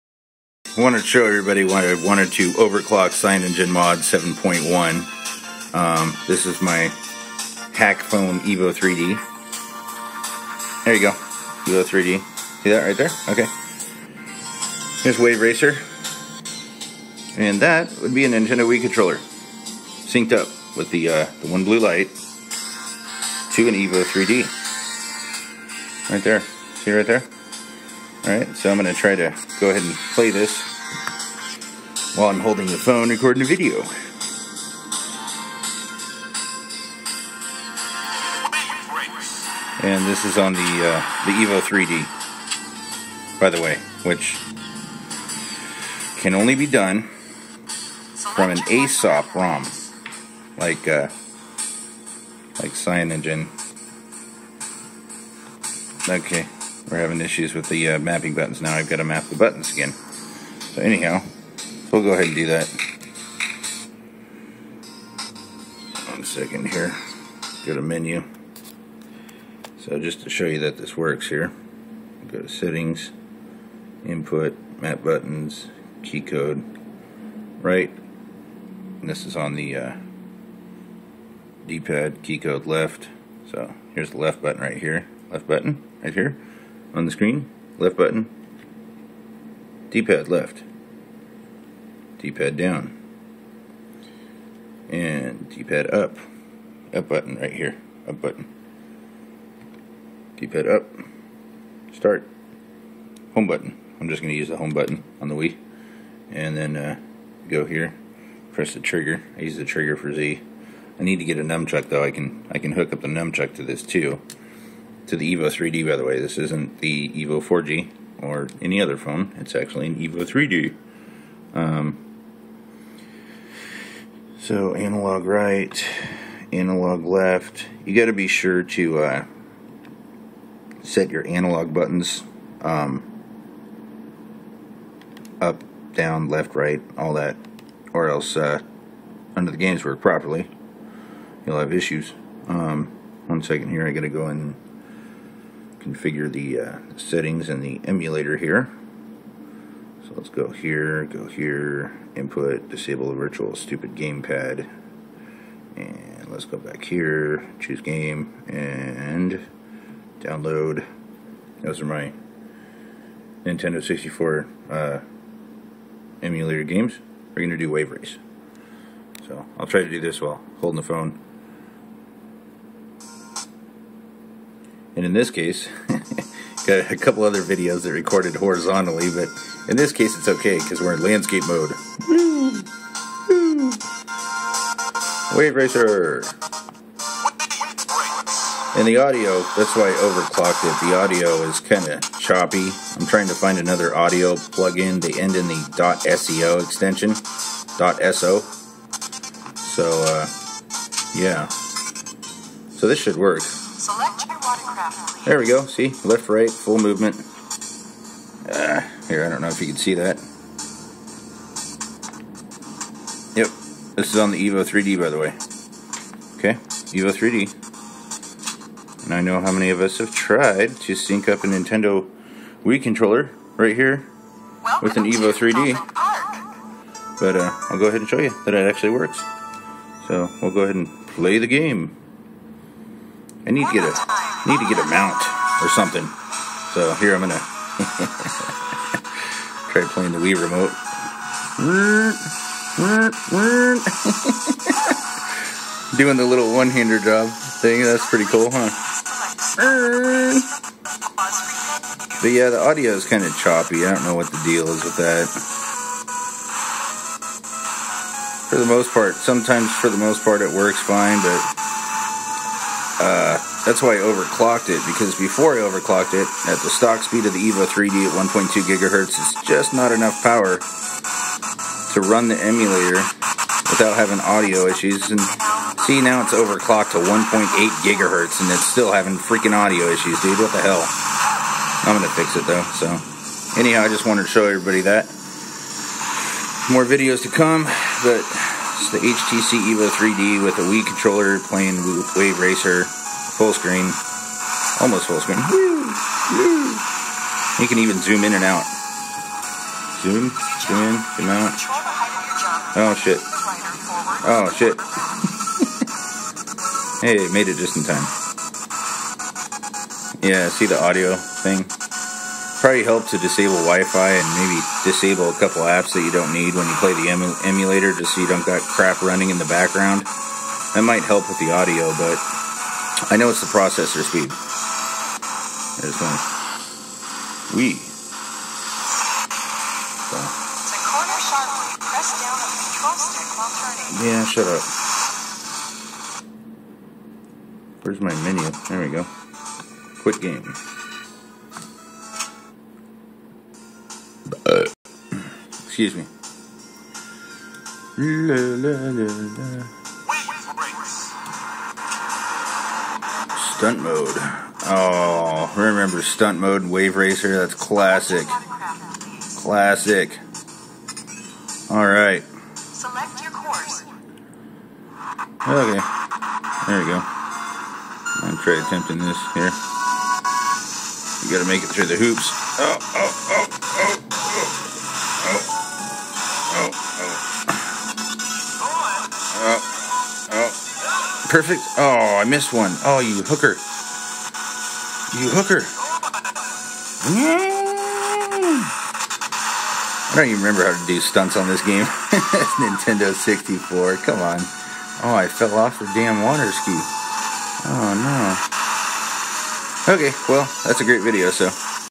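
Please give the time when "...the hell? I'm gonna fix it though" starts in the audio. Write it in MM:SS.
04:40.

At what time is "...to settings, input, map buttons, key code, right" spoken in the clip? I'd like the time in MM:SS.
01:12.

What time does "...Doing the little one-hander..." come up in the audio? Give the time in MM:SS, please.
04:05.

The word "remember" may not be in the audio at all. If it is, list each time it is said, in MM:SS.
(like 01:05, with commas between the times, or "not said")
05:55, 06:30.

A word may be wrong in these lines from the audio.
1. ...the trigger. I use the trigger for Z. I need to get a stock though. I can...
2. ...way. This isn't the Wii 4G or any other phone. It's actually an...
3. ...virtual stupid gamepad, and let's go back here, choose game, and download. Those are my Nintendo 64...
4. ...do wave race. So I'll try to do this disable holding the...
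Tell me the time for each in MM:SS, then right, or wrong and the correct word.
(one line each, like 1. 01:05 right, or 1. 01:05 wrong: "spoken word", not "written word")
1. 01:48 wrong: "nunchuck", not "stock"
2. 01:56 wrong: "Evo", not "Wii"
3. 02:33 right
4. 02:47 wrong: "while", not "disable".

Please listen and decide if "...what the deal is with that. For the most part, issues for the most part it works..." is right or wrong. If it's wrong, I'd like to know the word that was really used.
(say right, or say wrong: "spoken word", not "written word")
wrong: "sometimes", not "issues".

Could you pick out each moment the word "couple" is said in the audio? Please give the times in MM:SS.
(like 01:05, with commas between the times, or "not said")
02:56, 05:15.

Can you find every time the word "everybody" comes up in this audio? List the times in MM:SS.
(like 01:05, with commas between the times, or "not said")
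00:01, 04:44.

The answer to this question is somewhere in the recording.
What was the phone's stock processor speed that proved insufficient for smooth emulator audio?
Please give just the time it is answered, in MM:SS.
04:28.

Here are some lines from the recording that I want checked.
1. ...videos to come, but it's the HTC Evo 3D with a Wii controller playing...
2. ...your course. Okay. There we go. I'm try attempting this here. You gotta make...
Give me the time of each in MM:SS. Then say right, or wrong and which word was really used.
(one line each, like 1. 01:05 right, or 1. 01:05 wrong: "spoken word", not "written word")
1. 04:46 right
2. 06:03 right.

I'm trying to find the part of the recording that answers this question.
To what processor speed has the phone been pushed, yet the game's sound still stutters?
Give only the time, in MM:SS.
04:37.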